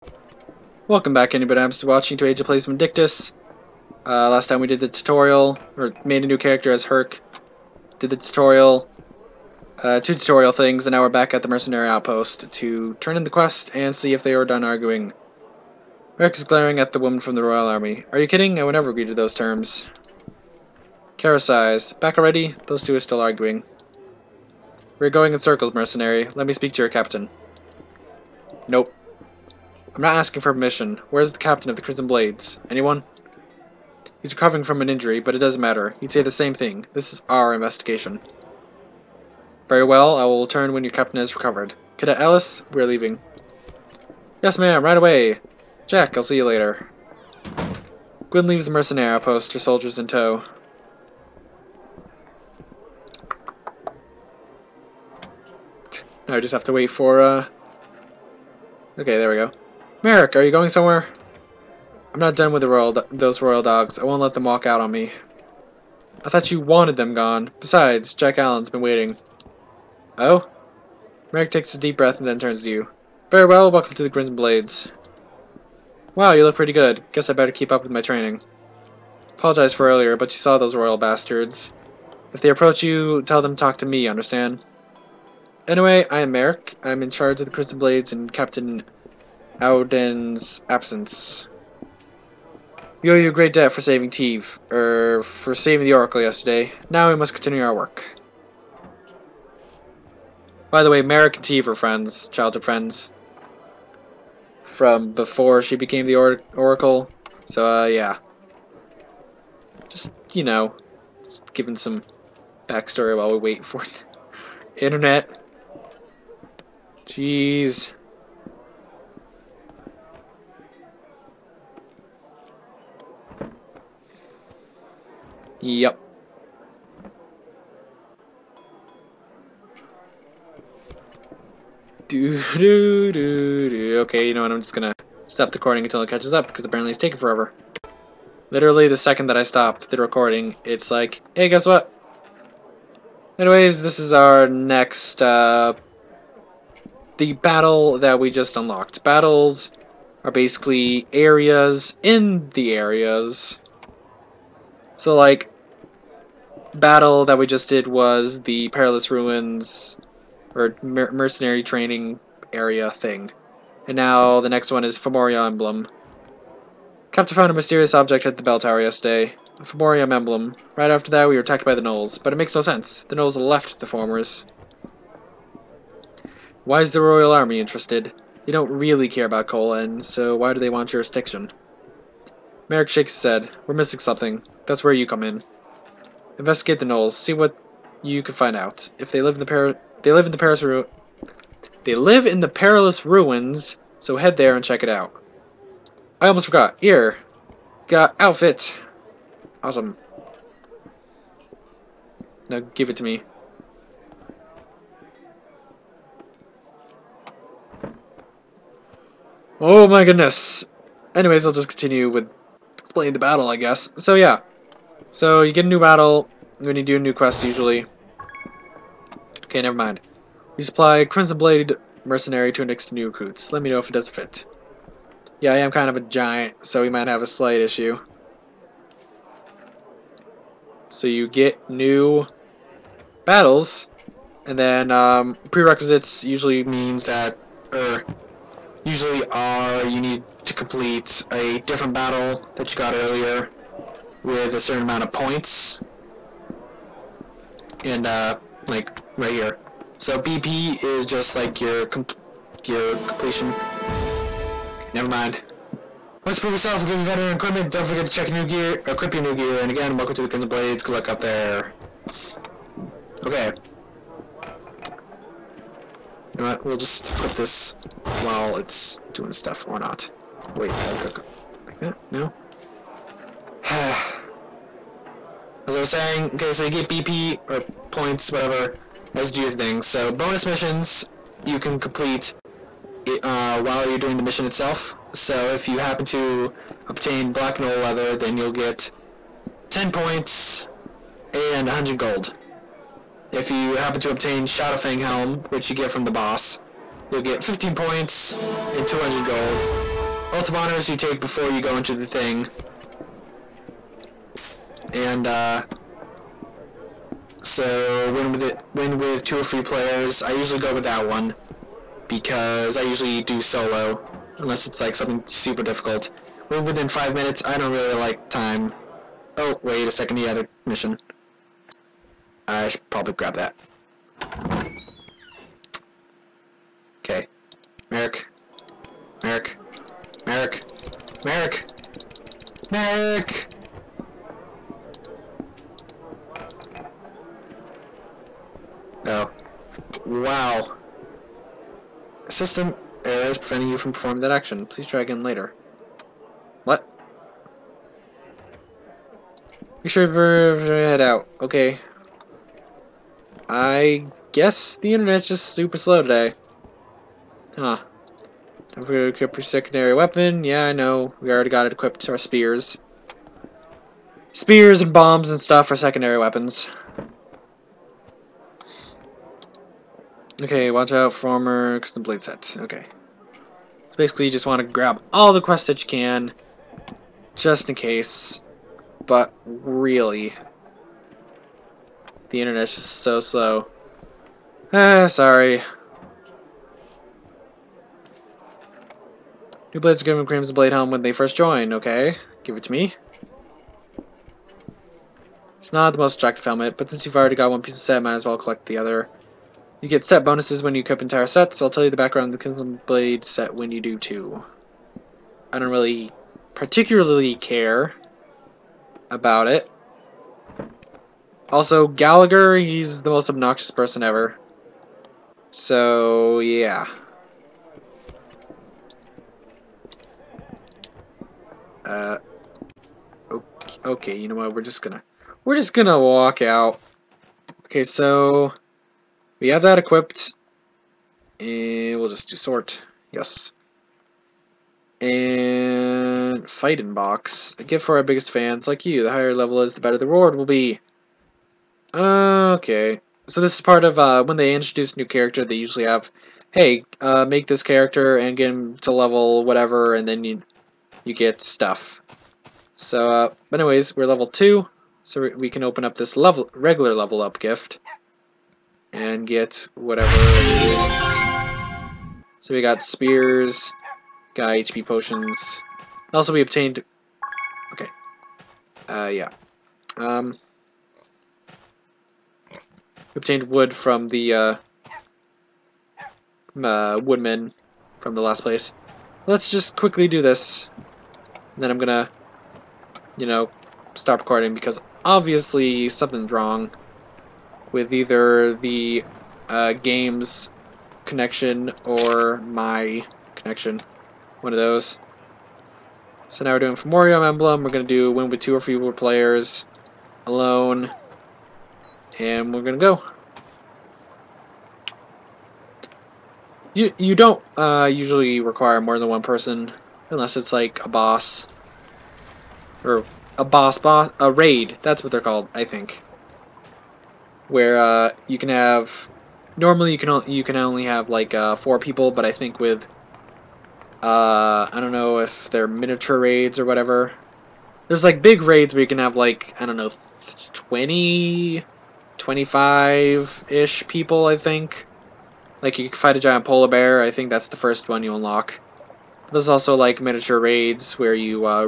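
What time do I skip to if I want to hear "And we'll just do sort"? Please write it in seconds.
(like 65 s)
431 s.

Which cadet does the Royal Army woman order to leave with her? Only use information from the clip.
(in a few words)
Ellis.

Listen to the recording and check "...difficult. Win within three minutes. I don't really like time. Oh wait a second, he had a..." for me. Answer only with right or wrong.
wrong.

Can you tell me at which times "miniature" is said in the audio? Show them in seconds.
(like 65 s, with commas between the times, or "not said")
525 s, 540 s.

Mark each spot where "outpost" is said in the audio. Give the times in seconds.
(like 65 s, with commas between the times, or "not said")
11 s, 49 s.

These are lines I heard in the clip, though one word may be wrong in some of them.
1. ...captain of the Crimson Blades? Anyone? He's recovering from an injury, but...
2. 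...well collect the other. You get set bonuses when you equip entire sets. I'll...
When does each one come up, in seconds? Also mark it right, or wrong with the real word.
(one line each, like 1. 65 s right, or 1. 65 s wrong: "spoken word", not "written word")
1. 31 s right
2. 398 s right.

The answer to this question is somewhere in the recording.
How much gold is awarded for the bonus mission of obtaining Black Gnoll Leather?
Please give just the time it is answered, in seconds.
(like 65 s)
291 s.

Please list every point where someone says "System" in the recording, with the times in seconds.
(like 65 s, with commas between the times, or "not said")
342 s.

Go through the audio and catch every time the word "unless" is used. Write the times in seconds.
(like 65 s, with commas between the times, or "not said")
314 s, 510 s.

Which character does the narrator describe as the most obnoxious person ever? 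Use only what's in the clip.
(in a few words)
Gallagher.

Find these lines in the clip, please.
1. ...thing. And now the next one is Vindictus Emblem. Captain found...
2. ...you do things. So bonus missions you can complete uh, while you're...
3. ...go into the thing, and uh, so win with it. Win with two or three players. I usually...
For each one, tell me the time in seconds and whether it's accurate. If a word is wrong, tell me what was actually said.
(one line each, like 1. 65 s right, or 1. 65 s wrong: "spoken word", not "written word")
1. 162 s wrong: "Fomorian", not "Vindictus"
2. 279 s right
3. 301 s right.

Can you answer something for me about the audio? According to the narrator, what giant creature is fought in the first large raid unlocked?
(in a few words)
polar bear.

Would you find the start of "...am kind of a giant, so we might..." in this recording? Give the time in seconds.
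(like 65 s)
225 s.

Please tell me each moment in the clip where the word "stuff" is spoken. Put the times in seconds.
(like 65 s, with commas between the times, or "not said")
269 s, 365 s, 451 s.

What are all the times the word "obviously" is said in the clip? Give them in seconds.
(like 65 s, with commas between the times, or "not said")
485 s.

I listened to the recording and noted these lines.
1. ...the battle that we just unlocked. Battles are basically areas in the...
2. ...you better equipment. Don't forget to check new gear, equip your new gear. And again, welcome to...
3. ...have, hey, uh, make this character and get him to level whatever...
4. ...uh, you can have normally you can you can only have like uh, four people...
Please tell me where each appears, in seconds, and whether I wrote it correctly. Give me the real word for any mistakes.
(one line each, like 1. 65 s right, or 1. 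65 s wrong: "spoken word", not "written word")
1. 147 s right
2. 256 s right
3. 445 s right
4. 517 s right.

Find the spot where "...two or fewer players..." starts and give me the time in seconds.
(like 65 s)
498 s.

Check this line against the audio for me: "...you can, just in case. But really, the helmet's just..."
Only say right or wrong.
wrong.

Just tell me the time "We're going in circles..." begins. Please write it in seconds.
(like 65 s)
24 s.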